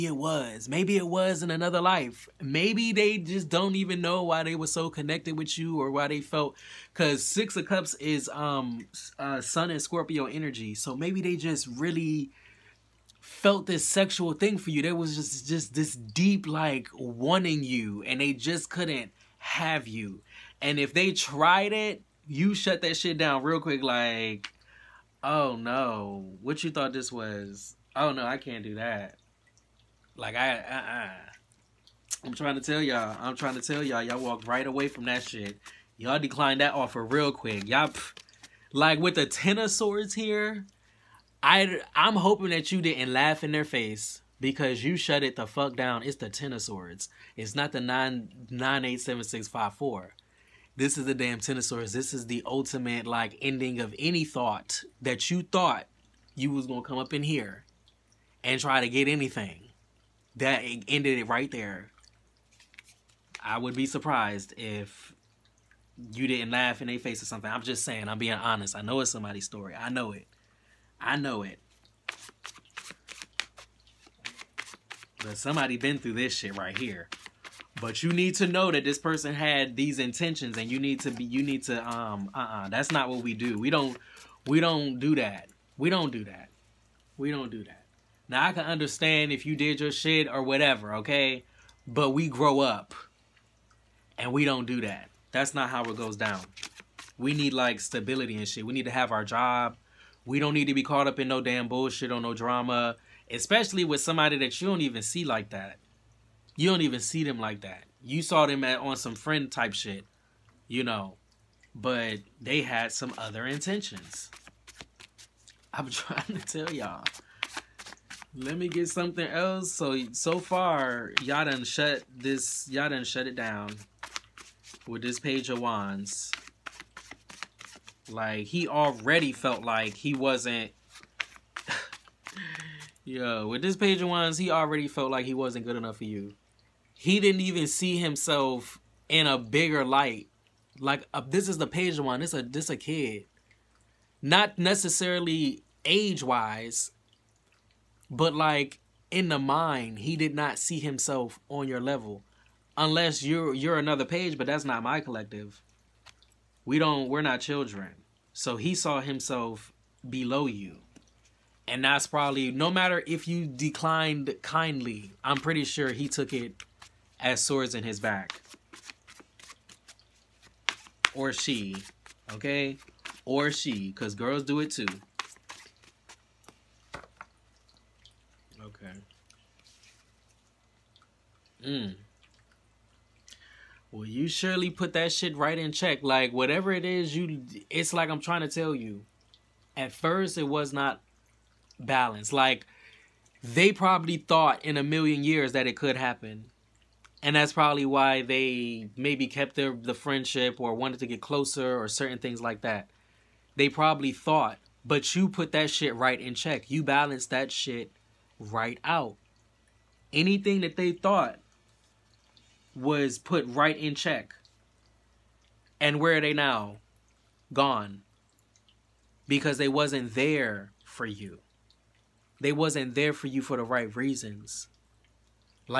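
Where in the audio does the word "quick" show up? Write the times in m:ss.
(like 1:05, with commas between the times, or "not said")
0:23, 0:37.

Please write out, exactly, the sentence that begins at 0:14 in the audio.
There was just just this deep like wanting you, and they just couldn't have you.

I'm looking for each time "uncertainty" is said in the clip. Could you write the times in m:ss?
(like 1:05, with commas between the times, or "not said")
not said.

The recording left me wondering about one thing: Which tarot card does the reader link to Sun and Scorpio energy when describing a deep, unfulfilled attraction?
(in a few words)
Six of Cups.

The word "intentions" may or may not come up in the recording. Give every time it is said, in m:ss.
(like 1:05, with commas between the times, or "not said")
1:19, 1:53.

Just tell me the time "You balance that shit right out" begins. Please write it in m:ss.
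3:26.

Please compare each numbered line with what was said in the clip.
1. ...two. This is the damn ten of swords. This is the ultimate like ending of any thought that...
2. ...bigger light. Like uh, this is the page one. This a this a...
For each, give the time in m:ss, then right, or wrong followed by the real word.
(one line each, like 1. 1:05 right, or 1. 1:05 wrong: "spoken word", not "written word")
1. 0:49 wrong: "four", not "two"
2. 2:19 right.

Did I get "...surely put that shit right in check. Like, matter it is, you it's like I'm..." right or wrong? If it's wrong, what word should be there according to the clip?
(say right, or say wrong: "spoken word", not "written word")
wrong: "whatever", not "matter".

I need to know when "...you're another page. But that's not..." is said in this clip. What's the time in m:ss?
2:33.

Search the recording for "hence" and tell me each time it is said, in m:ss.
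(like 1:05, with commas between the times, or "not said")
not said.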